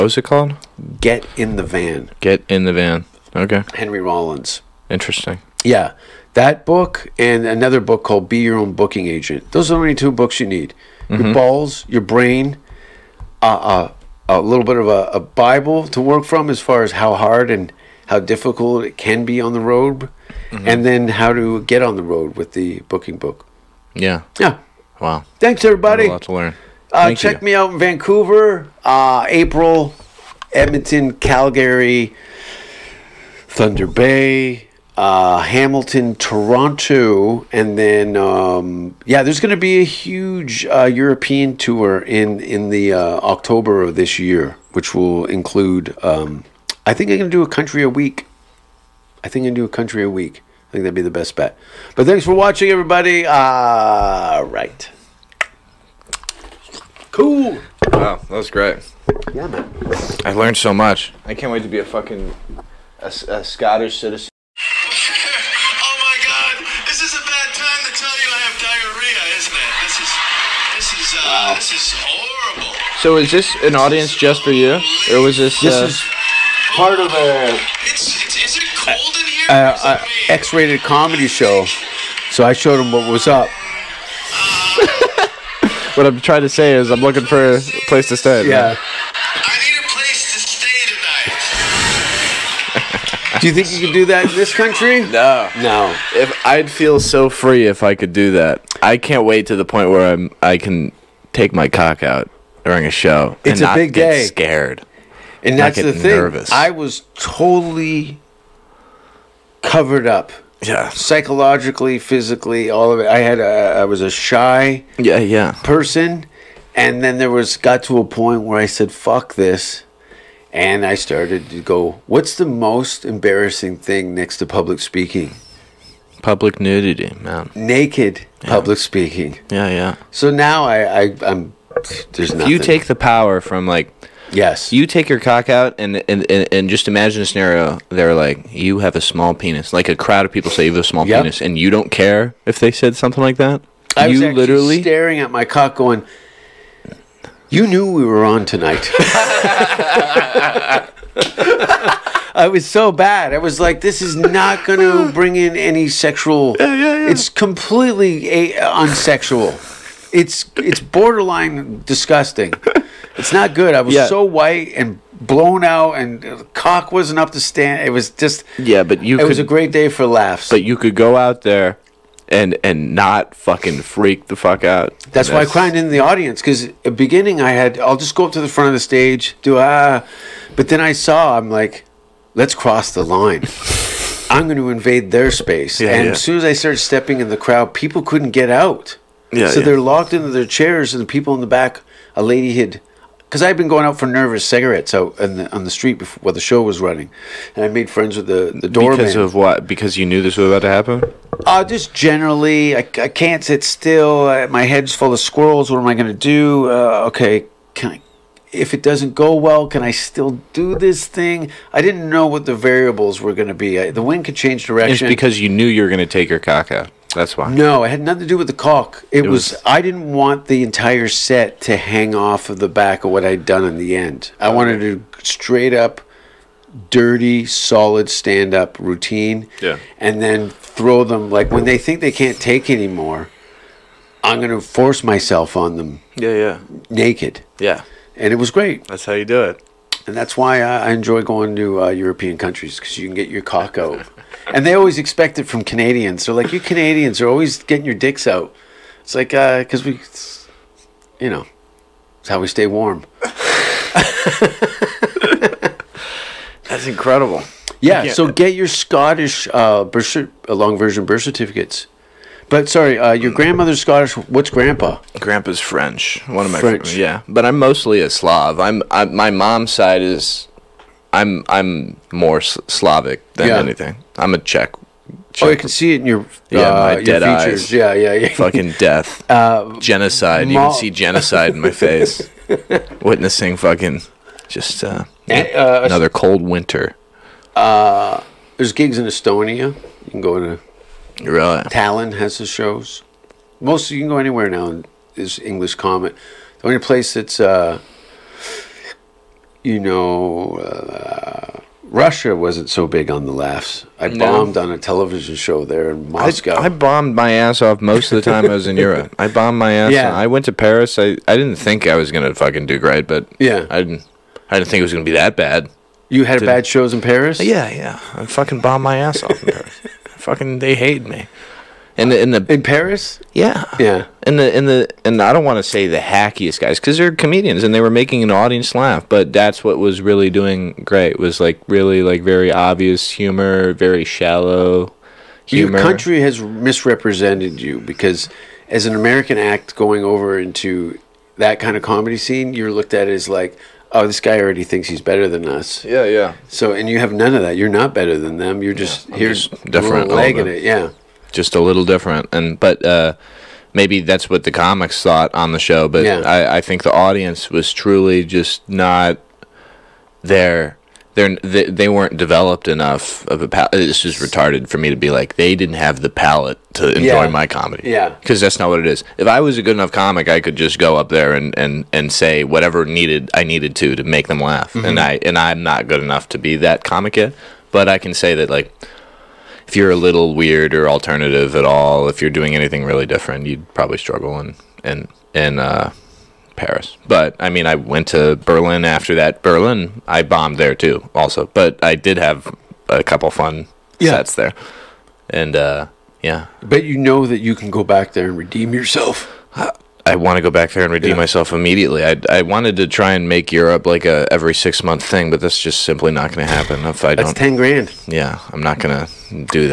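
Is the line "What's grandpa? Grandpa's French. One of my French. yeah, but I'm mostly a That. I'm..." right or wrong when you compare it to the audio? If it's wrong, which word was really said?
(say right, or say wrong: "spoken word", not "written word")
wrong: "Slav", not "That".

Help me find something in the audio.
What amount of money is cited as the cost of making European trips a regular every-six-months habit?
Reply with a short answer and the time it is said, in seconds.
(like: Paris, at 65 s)
ten grand, at 407 s.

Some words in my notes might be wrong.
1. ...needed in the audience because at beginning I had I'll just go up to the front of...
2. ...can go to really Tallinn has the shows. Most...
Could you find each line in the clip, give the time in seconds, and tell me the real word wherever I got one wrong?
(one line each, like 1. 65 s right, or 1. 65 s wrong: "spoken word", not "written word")
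1. 175 s wrong: "cried", not "needed"
2. 290 s right.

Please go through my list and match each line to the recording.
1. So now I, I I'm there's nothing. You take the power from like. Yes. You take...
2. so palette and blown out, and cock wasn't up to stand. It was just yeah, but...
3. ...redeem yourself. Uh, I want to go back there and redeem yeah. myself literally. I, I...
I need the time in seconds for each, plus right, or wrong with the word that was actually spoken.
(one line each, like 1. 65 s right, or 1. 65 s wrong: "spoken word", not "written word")
1. 130 s right
2. 164 s wrong: "white", not "palette"
3. 398 s wrong: "immediately", not "literally".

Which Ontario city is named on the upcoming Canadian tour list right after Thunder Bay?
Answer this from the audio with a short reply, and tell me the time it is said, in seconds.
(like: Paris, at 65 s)
Hamilton, at 35 s.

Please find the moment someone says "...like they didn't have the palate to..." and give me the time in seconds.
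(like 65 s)
365 s.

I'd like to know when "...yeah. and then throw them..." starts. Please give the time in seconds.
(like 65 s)
229 s.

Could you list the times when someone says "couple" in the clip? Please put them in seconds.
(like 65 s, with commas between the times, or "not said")
393 s.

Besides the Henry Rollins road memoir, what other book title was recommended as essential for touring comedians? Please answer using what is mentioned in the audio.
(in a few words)
Be Your Own Booking Agent.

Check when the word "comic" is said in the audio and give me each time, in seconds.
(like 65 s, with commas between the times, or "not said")
354 s, 369 s, 376 s.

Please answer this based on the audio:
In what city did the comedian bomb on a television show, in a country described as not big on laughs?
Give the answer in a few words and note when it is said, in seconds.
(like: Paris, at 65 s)
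Moscow, at 306 s.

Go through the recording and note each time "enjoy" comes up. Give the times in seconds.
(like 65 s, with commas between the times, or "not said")
240 s, 366 s.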